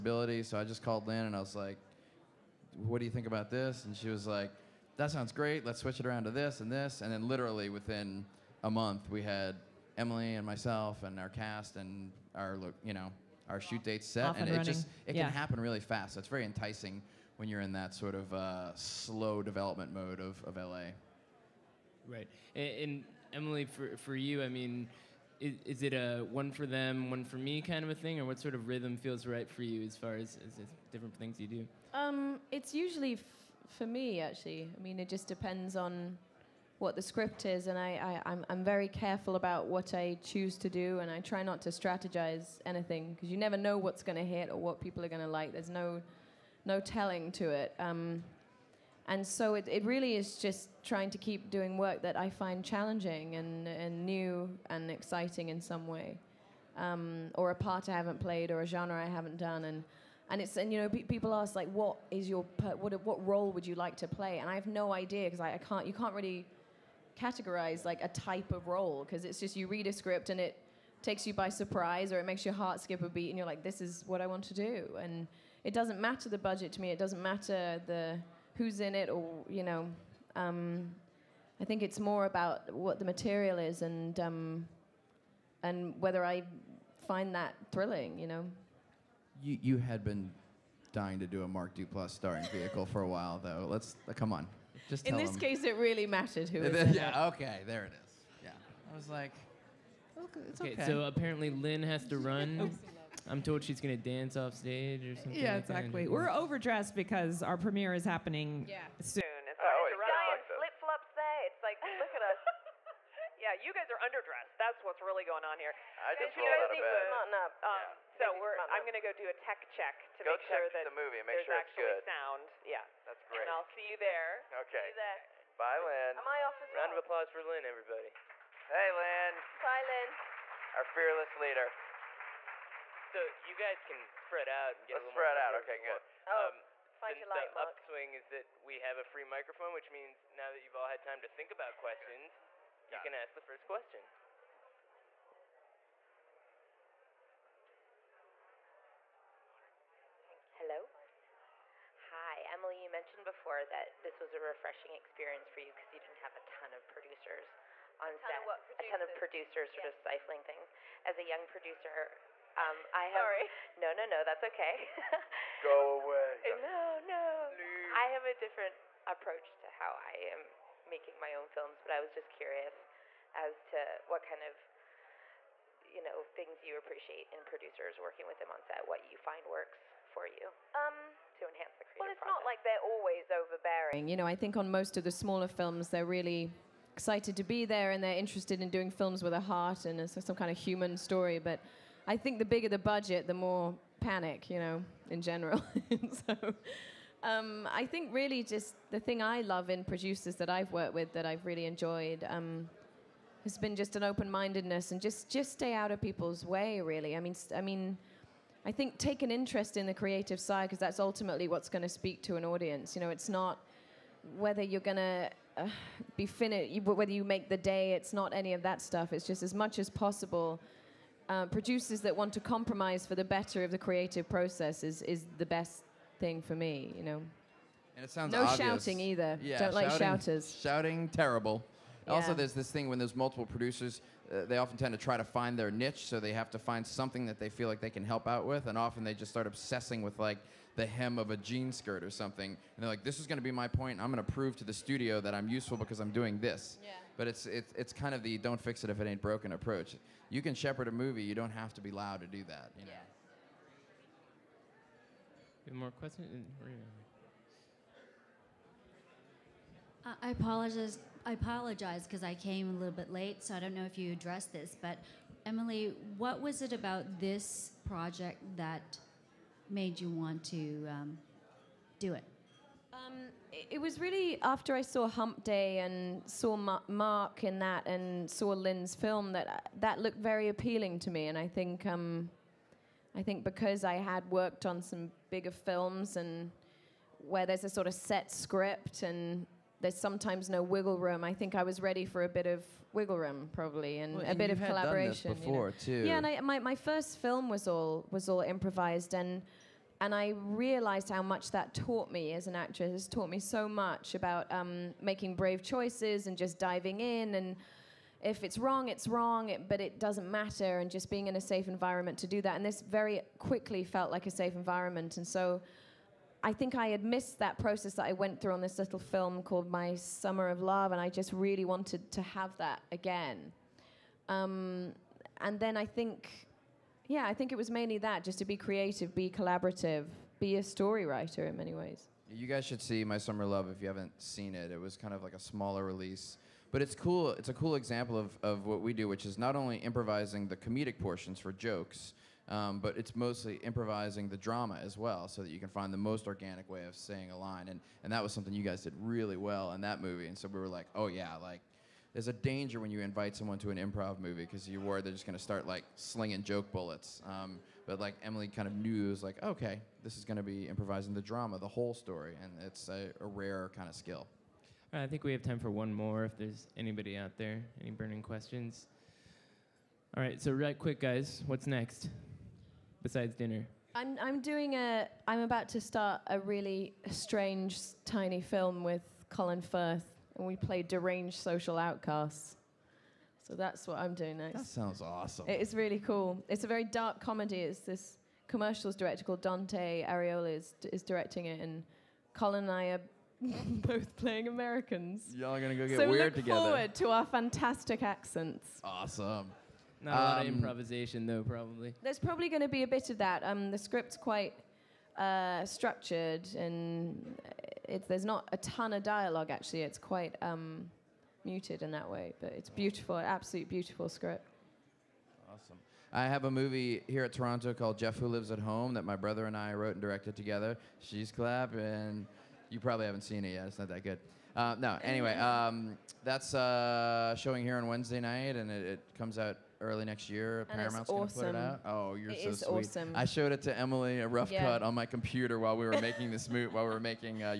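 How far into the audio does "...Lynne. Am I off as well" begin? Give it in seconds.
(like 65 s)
125 s.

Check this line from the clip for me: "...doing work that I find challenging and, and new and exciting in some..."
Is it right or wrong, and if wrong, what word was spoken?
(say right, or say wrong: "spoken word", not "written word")
right.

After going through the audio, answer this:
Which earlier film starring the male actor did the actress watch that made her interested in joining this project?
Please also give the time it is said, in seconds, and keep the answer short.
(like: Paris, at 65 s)
Hump Day, at 275 s.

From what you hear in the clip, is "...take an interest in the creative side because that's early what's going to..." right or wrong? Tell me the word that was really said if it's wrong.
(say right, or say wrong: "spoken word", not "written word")
wrong: "ultimately", not "early".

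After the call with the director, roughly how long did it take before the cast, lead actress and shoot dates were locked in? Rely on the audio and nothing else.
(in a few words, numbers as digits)
a month.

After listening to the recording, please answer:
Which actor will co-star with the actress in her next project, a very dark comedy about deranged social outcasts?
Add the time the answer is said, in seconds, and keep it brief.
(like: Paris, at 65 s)
Colin Firth, at 379 s.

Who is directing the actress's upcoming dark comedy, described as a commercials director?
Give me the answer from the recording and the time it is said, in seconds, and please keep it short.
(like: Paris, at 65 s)
Dante Ariola, at 389 s.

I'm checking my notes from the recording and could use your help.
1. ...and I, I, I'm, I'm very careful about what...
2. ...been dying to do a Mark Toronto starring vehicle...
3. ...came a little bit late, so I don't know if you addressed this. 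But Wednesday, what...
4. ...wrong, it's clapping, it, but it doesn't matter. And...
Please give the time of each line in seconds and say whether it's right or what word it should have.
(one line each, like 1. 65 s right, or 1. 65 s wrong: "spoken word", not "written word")
1. 37 s right
2. 90 s wrong: "Duplass", not "Toronto"
3. 262 s wrong: "Emily", not "Wednesday"
4. 308 s wrong: "wrong", not "clapping".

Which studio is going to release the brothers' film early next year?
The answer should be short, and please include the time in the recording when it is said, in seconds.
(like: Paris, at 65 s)
Paramount, at 430 s.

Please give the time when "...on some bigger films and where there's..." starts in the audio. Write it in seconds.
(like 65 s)
284 s.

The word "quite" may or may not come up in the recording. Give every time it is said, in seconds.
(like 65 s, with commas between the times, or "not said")
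404 s, 409 s.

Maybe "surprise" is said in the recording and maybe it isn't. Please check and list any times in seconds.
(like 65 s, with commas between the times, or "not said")
71 s.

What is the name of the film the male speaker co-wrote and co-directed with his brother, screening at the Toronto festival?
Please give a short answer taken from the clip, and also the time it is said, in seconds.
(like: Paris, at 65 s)
Jeff Who Lives at Home, at 417 s.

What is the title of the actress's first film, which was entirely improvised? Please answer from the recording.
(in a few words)
My Summer of Love.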